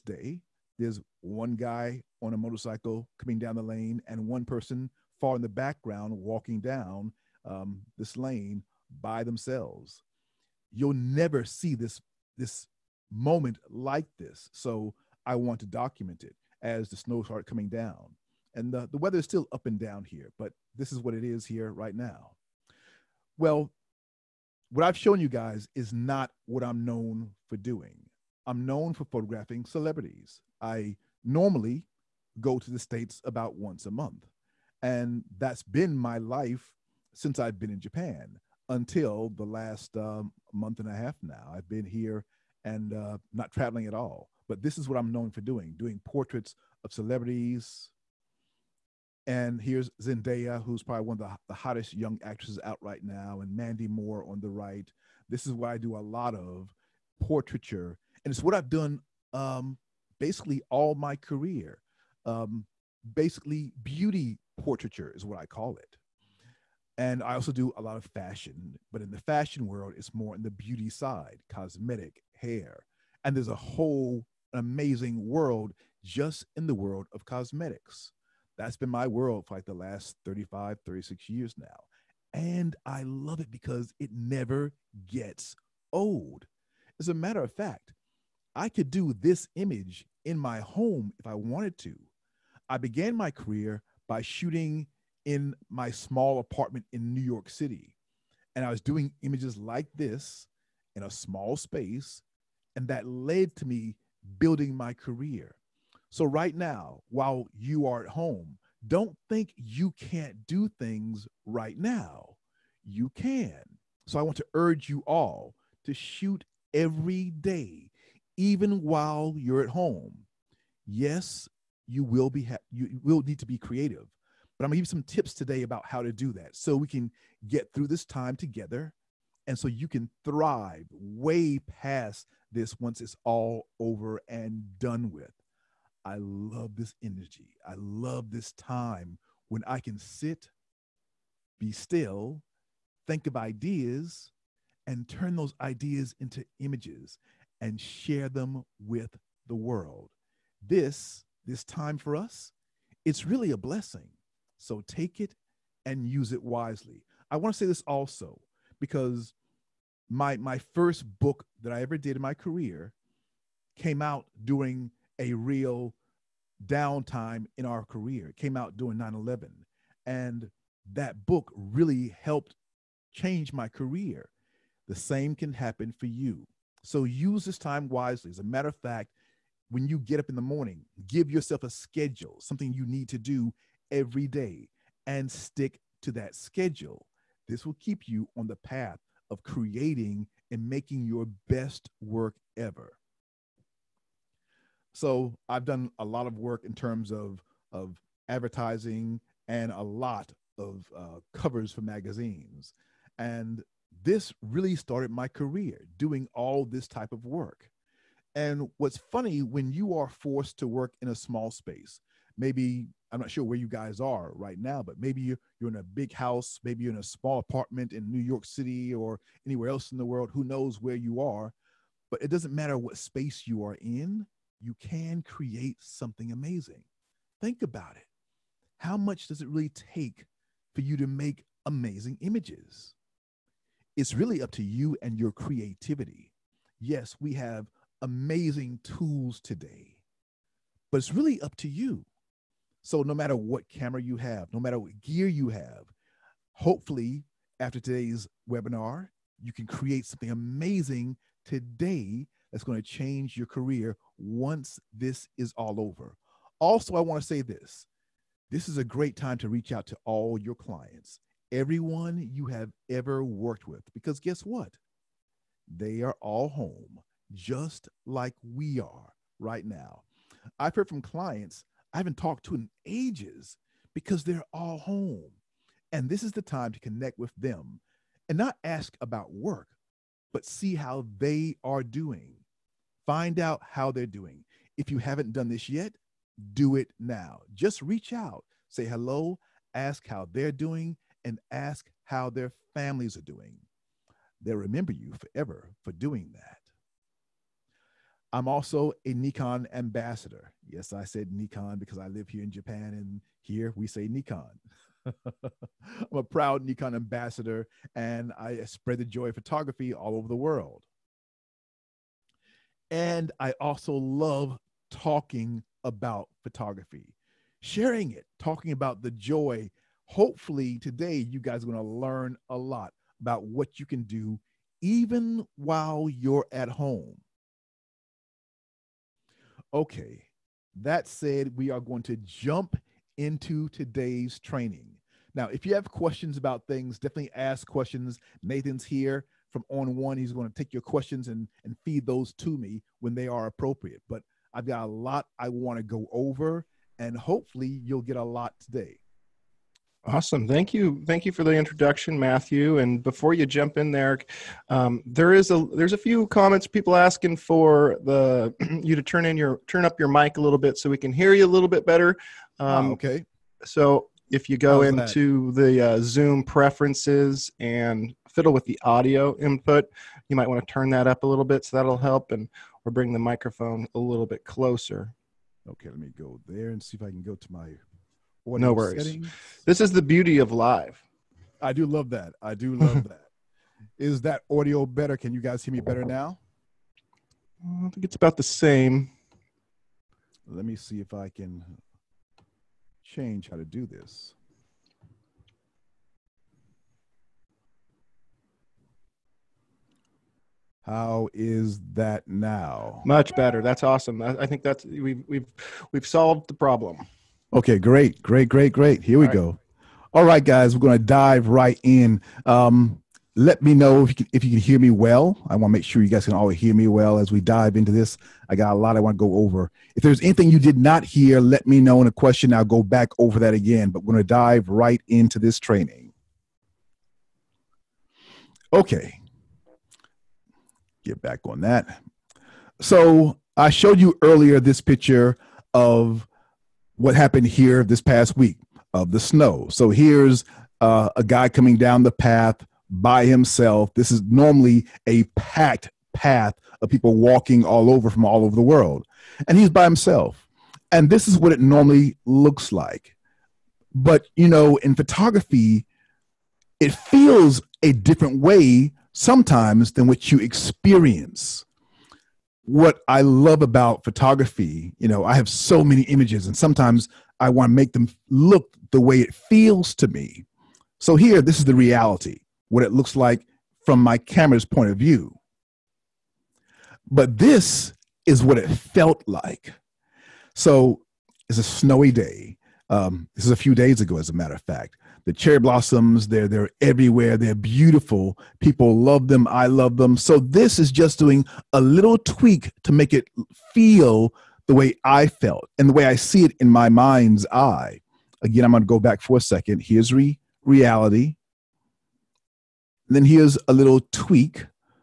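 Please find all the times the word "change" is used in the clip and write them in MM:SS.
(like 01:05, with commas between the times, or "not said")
02:53, 04:12, 06:33.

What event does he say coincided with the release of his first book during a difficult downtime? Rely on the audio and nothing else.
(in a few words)
9/11.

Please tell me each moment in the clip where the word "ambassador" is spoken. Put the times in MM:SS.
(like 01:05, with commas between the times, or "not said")
04:59, 05:06.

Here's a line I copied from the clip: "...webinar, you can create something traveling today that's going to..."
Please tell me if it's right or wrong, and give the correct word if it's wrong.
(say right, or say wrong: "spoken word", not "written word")
wrong: "amazing", not "traveling".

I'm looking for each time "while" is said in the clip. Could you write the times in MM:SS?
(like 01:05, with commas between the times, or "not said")
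01:47, 01:58, 05:25.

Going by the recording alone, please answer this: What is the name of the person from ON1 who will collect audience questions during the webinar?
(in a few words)
Nathan.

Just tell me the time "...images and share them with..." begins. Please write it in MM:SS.
02:26.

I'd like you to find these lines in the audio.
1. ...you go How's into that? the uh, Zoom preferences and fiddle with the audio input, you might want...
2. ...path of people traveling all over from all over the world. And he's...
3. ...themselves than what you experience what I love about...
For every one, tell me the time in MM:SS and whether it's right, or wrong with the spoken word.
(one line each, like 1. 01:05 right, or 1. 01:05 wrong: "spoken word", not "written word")
1. 06:04 right
2. 07:26 wrong: "walking", not "traveling"
3. 07:39 wrong: "sometimes", not "themselves".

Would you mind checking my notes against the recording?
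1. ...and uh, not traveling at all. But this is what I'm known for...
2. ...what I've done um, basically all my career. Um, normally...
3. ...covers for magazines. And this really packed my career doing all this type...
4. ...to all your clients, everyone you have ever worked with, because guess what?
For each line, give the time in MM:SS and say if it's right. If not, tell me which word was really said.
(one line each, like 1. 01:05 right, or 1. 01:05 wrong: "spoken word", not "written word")
1. 00:42 right
2. 00:58 wrong: "basically", not "normally"
3. 03:21 wrong: "started", not "packed"
4. 04:19 right.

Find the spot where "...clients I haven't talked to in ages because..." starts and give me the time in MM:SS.
04:31.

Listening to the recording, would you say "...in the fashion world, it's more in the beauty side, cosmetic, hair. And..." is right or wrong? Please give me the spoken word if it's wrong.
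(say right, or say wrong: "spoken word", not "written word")
right.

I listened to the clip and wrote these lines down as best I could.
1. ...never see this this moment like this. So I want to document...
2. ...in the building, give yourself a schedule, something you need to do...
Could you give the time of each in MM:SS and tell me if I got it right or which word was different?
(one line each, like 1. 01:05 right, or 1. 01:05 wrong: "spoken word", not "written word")
1. 00:10 right
2. 03:00 wrong: "morning", not "building".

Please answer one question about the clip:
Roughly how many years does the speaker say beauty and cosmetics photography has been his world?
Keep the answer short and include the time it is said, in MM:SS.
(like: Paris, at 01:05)
35, 36, at 01:20.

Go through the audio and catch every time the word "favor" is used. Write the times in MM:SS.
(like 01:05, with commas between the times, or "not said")
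not said.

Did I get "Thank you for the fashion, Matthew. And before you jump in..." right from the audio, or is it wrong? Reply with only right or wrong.
wrong.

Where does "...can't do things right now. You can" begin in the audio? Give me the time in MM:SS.
01:49.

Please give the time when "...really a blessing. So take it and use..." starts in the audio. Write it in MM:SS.
02:33.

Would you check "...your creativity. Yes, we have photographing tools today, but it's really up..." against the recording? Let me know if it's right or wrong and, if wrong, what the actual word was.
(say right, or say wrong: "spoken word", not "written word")
wrong: "amazing", not "photographing".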